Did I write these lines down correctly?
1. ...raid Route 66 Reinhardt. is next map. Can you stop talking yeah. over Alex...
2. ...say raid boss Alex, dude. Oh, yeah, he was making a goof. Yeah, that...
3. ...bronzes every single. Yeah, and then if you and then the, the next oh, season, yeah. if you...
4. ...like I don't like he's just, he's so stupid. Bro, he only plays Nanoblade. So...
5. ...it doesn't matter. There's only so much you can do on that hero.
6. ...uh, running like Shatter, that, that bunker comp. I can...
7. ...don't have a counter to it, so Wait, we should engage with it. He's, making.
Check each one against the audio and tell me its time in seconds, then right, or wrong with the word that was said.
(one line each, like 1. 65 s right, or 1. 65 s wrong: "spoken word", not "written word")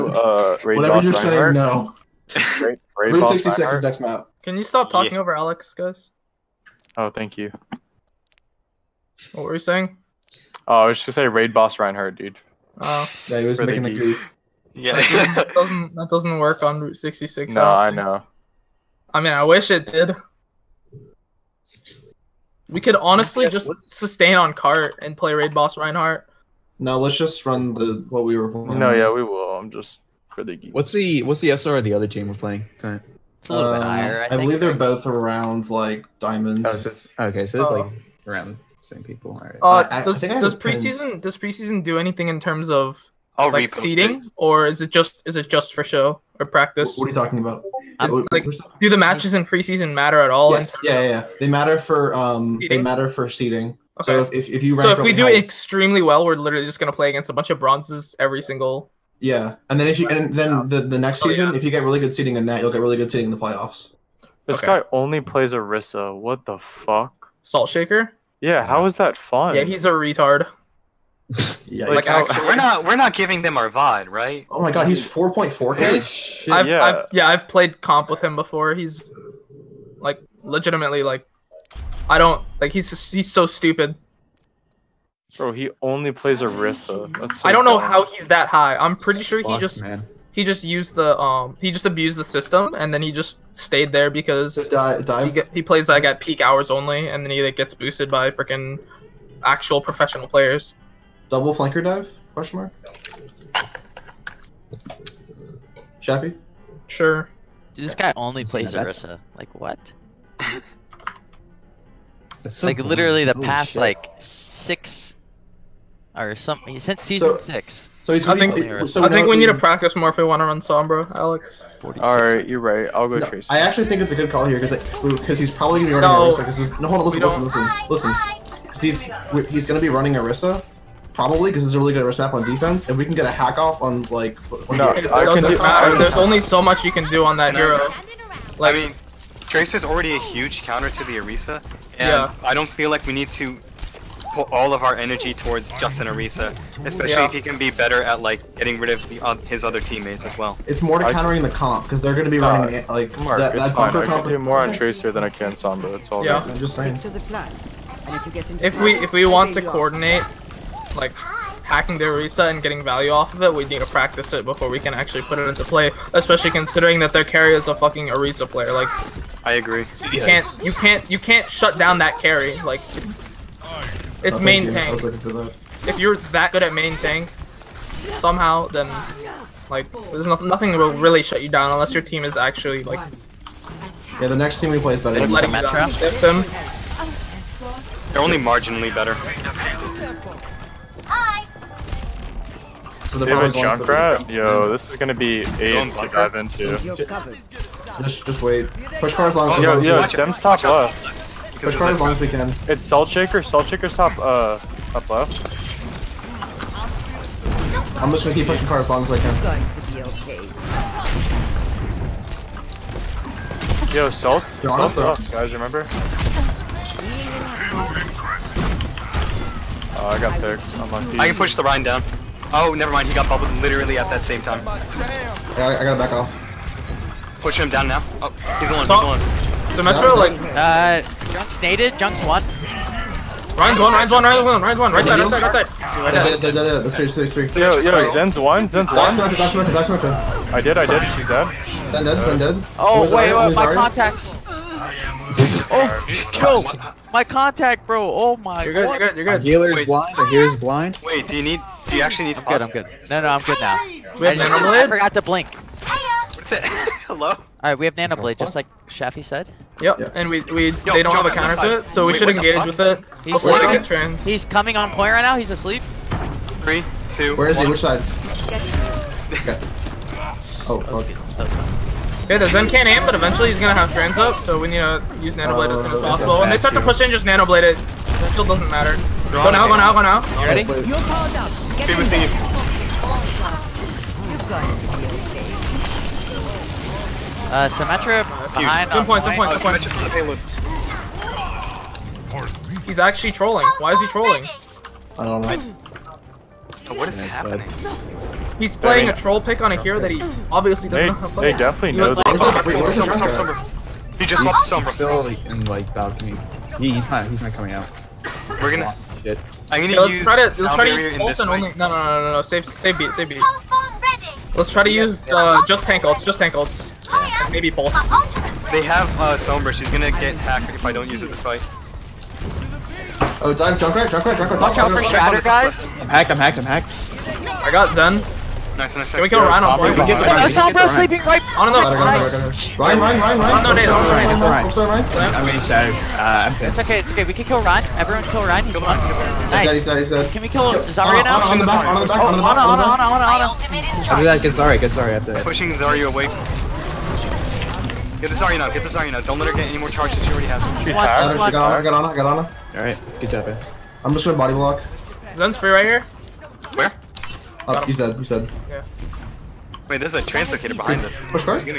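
1. 2 s right
2. 11 s wrong: "Reinhardt", not "Alex"
3. 57 s right
4. 81 s wrong: "Orisa", not "Nanoblade"
5. 134 s right
6. 152 s wrong: "Mark", not "Shatter"
7. 261 s wrong: "sleeping", not "making".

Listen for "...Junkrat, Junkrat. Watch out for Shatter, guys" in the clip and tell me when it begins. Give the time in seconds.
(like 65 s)
324 s.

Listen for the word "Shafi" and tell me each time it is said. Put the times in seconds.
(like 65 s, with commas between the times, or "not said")
106 s, 258 s.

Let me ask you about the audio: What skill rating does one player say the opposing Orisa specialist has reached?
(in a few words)
4.4K.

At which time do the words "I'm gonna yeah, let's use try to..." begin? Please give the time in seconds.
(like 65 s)
309 s.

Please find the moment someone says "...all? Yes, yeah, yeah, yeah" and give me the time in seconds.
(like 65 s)
50 s.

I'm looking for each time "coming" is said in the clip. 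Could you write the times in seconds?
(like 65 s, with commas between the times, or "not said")
264 s, 307 s.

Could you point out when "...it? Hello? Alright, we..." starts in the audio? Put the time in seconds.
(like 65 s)
256 s.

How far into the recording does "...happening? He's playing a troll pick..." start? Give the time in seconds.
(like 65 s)
297 s.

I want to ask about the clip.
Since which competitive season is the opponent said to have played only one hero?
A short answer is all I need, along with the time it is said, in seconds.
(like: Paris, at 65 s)
season 6, at 116 s.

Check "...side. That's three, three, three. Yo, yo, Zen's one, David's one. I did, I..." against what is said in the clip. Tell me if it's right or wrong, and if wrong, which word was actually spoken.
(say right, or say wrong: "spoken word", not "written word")
wrong: "Zen", not "David".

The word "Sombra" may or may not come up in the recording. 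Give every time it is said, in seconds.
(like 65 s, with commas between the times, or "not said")
120 s, 155 s, 304 s, 319 s, 330 s.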